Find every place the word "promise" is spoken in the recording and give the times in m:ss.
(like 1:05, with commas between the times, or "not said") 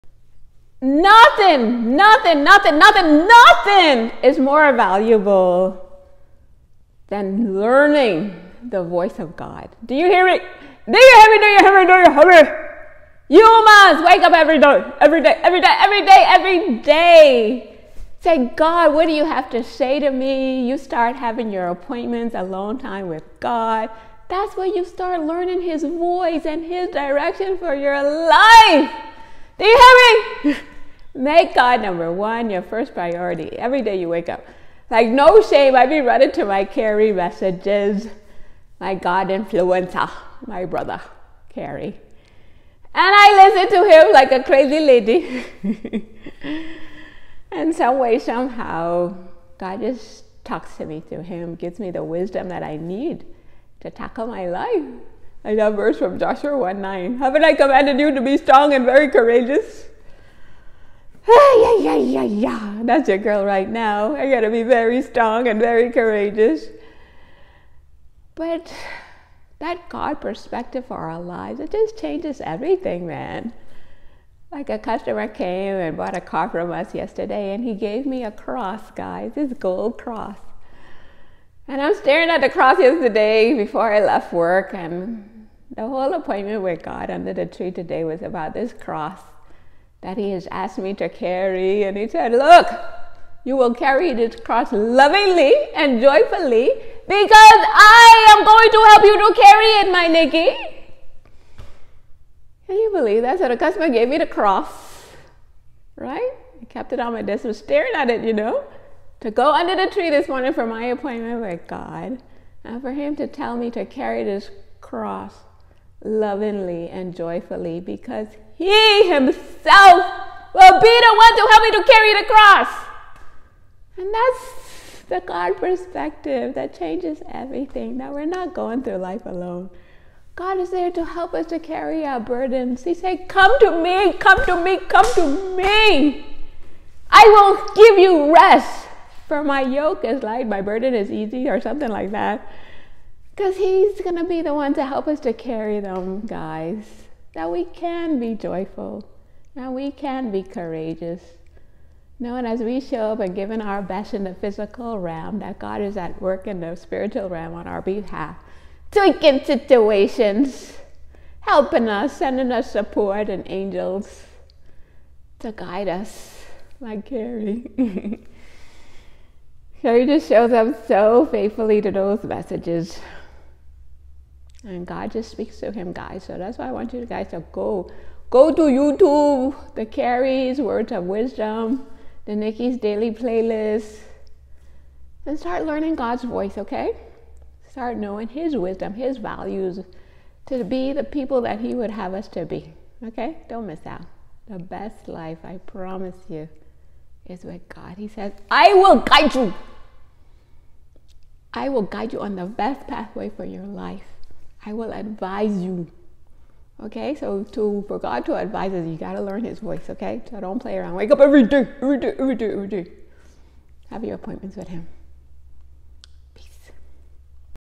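3:15.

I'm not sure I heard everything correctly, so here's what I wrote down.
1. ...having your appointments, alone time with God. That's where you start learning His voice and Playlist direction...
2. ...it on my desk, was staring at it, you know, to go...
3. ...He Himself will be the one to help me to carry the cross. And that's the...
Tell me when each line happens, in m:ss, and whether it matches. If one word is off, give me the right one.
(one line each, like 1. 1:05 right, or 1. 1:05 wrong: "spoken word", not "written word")
1. 0:21 wrong: "His", not "Playlist"
2. 1:46 right
3. 1:58 right.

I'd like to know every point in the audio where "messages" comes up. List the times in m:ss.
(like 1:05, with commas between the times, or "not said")
0:37, 2:52.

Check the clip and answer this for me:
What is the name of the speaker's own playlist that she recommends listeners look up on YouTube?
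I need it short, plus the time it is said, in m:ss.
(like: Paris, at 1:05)
Nikki's Daily Playlist, at 3:02.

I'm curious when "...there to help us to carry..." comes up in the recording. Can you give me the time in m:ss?
2:10.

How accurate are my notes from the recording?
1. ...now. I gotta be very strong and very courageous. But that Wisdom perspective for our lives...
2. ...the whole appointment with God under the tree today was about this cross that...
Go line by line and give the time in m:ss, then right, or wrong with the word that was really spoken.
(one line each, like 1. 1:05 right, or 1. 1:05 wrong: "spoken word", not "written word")
1. 1:03 wrong: "God", not "Wisdom"
2. 1:25 right.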